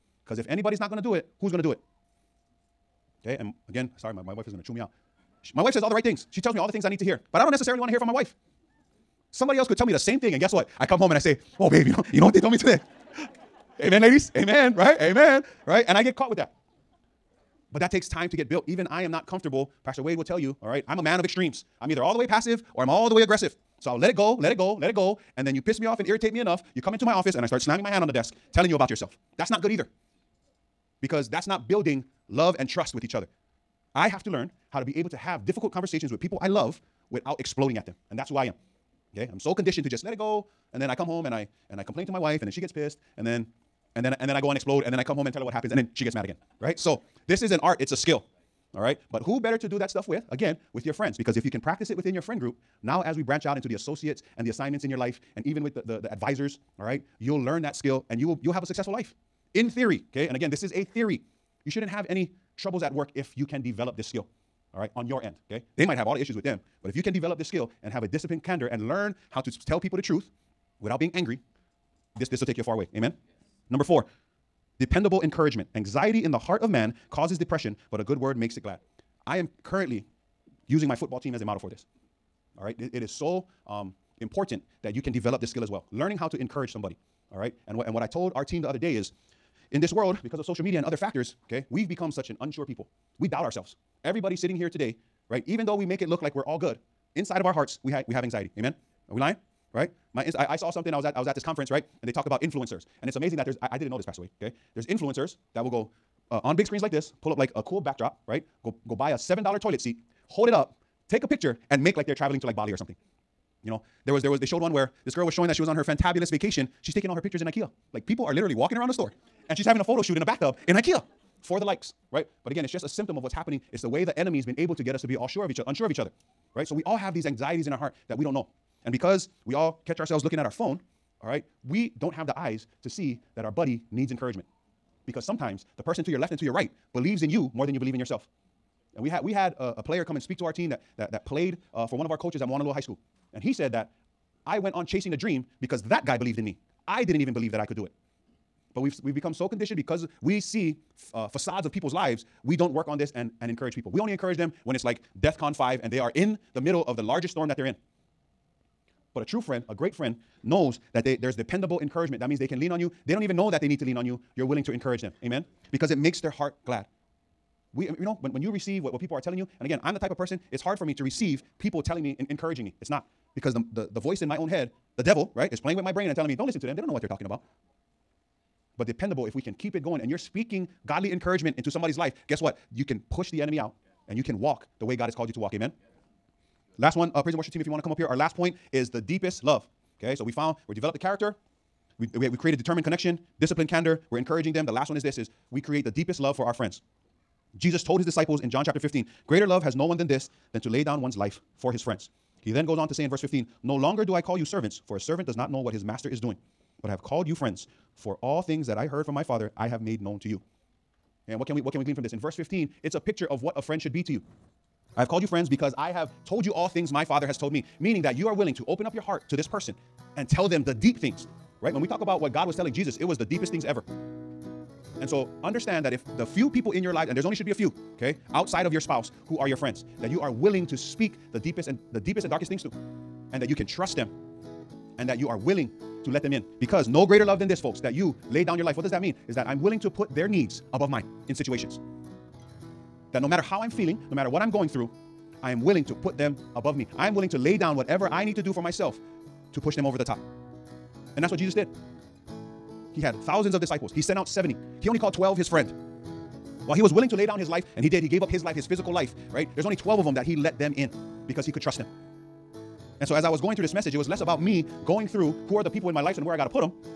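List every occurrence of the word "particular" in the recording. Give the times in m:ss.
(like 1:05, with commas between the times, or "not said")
not said.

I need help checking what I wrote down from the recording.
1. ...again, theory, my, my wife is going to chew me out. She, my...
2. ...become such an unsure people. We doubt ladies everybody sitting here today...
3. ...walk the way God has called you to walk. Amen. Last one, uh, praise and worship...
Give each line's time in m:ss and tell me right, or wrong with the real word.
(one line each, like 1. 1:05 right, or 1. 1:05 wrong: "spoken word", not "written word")
1. 0:03 wrong: "sorry", not "theory"
2. 1:31 wrong: "ourselves", not "ladies"
3. 3:04 right.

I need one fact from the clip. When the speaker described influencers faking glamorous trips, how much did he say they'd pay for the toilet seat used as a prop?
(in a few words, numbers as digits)
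$7.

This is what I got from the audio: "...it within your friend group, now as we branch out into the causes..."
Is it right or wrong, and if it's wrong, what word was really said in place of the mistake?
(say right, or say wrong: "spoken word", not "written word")
wrong: "associates", not "causes".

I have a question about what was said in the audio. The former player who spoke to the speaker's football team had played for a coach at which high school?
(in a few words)
Moanalua High School.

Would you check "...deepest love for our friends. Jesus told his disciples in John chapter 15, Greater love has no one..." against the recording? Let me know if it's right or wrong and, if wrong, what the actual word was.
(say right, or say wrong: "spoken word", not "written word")
right.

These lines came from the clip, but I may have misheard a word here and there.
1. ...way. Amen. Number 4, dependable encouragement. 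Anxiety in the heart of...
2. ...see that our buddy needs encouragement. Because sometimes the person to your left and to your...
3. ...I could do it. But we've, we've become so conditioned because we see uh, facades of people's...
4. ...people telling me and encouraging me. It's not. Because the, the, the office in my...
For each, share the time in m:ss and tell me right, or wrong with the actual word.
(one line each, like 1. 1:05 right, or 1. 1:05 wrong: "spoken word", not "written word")
1. 1:12 right
2. 2:12 right
3. 2:27 right
4. 2:51 wrong: "voice", not "office".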